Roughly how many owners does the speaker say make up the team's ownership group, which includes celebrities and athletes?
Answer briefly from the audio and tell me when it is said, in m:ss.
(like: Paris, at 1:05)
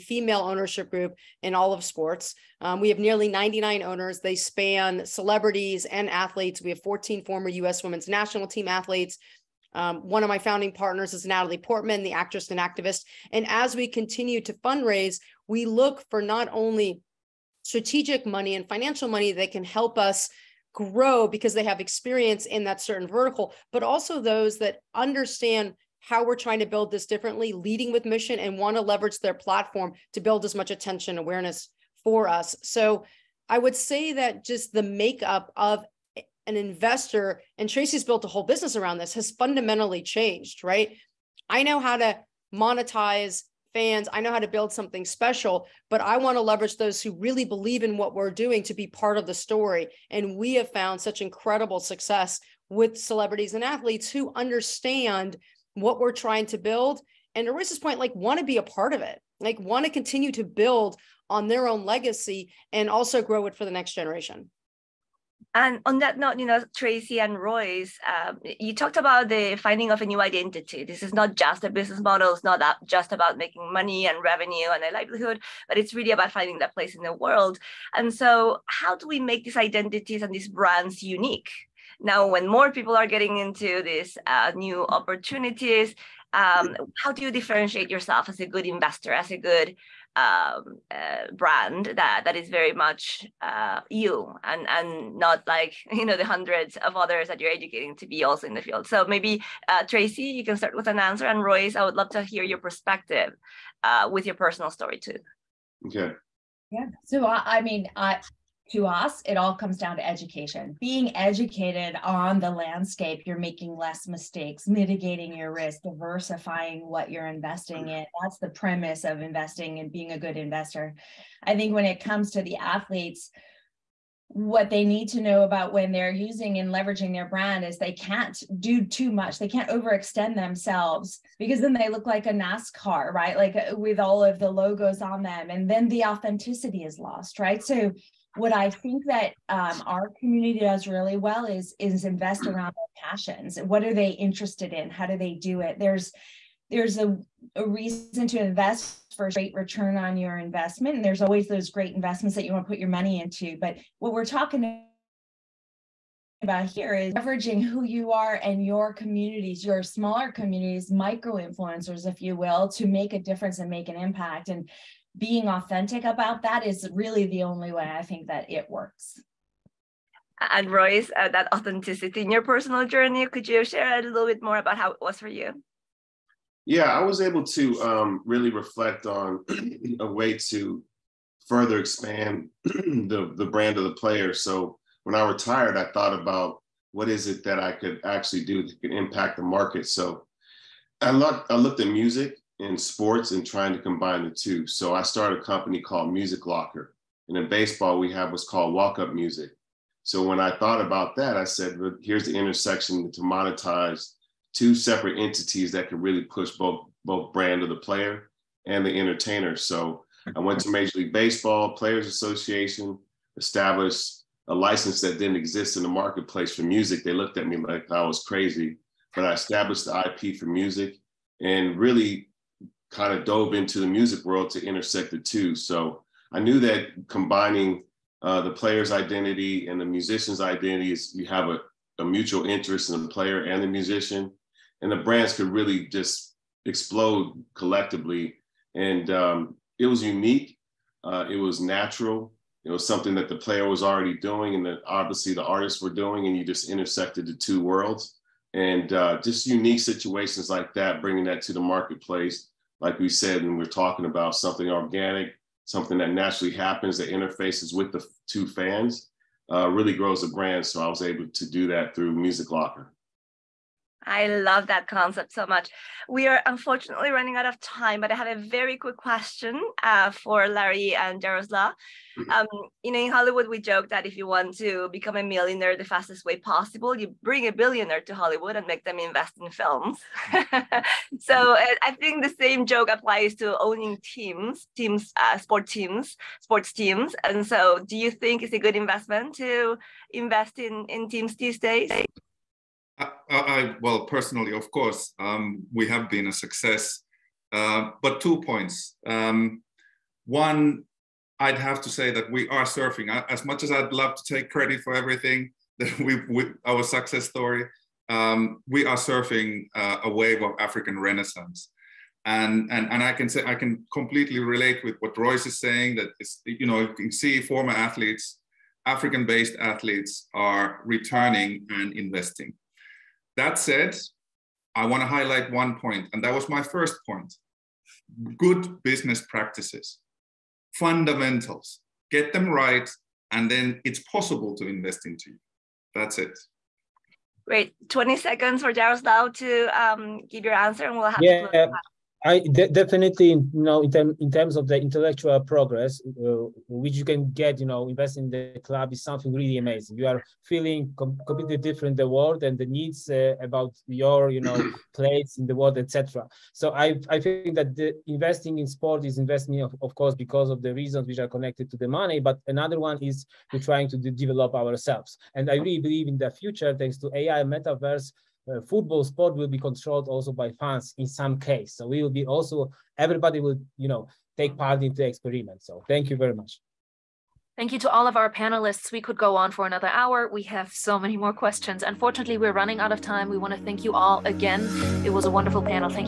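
99, at 0:03.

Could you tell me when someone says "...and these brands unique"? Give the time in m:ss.
1:20.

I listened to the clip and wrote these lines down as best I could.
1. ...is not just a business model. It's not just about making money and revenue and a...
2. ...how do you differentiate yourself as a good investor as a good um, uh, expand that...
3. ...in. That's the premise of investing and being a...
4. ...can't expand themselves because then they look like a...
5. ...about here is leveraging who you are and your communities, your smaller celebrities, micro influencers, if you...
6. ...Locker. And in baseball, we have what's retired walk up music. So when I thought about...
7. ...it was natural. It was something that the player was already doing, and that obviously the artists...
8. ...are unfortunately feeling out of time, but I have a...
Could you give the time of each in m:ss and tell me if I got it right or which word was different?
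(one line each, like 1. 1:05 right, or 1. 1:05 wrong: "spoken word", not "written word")
1. 1:11 right
2. 1:27 wrong: "brand", not "expand"
3. 1:57 right
4. 2:09 wrong: "overextend", not "expand"
5. 2:36 wrong: "communities", not "celebrities"
6. 3:16 wrong: "called", not "retired"
7. 4:01 right
8. 4:26 wrong: "running", not "feeling".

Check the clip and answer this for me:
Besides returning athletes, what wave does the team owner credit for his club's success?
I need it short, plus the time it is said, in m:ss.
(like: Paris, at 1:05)
African Renaissance, at 5:10.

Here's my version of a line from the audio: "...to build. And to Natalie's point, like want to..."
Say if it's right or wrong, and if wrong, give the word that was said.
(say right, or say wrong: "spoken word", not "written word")
wrong: "Rich", not "Natalie".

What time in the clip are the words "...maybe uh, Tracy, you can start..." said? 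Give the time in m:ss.
1:39.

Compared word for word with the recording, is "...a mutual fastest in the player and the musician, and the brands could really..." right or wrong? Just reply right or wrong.
wrong.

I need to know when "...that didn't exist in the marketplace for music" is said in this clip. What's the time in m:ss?
3:35.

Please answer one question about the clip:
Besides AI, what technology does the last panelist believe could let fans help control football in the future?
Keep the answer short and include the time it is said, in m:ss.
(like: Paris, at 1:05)
Metaverse, at 6:07.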